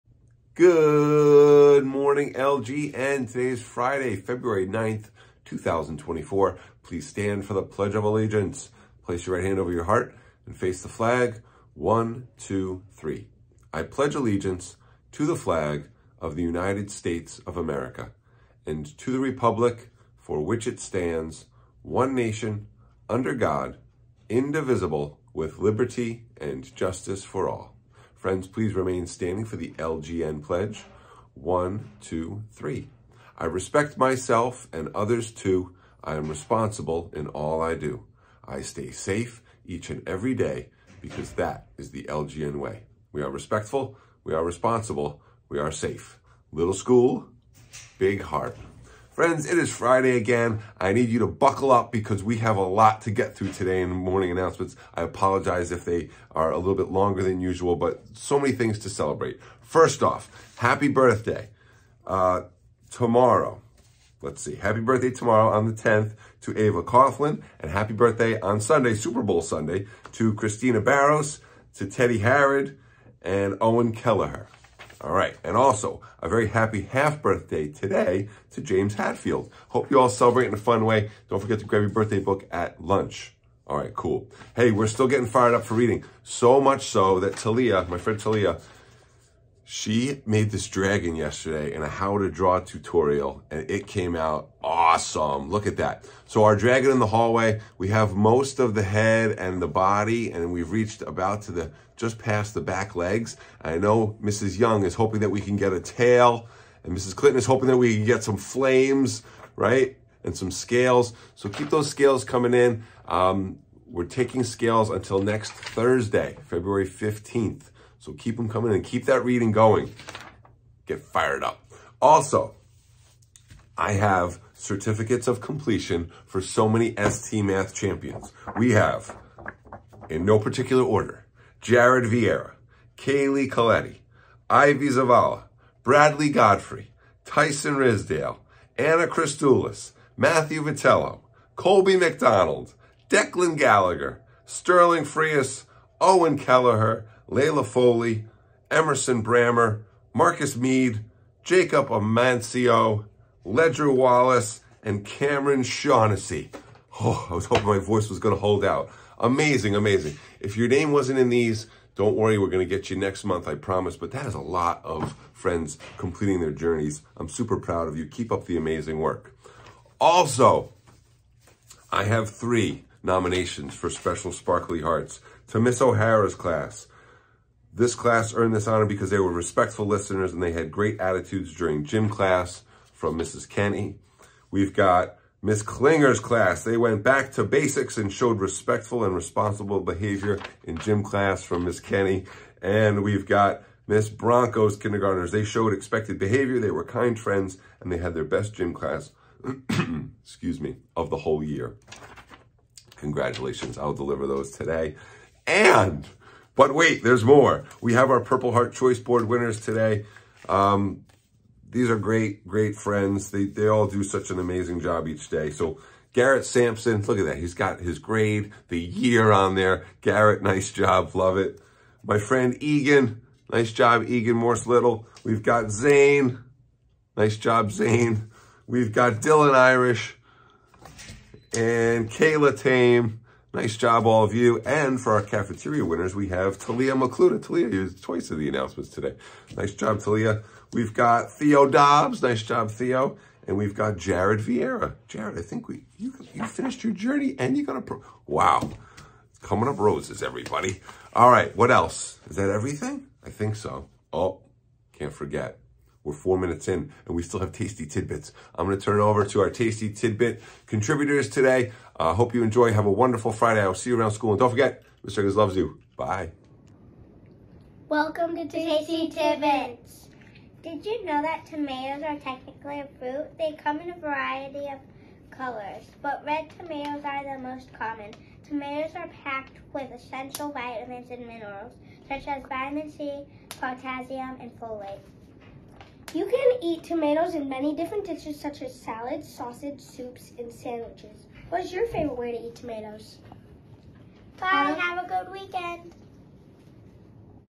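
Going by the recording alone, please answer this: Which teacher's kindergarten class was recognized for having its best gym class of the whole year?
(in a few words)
Miss Bronco.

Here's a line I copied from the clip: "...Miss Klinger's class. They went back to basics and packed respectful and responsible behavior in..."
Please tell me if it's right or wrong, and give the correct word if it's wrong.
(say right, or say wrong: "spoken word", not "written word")
wrong: "showed", not "packed".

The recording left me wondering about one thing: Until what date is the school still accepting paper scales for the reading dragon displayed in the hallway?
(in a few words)
February 15th.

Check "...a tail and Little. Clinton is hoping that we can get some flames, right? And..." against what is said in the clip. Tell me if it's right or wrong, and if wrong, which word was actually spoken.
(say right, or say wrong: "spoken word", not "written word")
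wrong: "Mrs", not "Little".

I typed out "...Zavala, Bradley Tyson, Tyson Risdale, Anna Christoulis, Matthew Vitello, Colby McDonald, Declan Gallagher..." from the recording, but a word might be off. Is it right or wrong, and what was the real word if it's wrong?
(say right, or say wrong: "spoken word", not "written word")
wrong: "Godfrey", not "Tyson".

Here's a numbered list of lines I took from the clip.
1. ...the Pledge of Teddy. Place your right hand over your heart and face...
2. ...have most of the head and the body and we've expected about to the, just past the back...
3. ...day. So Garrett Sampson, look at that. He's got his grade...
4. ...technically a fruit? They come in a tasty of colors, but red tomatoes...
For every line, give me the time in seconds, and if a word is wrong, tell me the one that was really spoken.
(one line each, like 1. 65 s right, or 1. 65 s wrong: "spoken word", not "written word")
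1. 7 s wrong: "Allegiance", not "Teddy"
2. 97 s wrong: "reached", not "expected"
3. 215 s right
4. 272 s wrong: "variety", not "tasty".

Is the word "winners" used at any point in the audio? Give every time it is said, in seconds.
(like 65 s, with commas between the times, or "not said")
209 s, 235 s.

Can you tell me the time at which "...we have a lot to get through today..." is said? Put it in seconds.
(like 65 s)
52 s.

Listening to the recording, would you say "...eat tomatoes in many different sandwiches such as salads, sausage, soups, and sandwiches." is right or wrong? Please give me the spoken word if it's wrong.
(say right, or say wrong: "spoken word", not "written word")
wrong: "dishes", not "sandwiches".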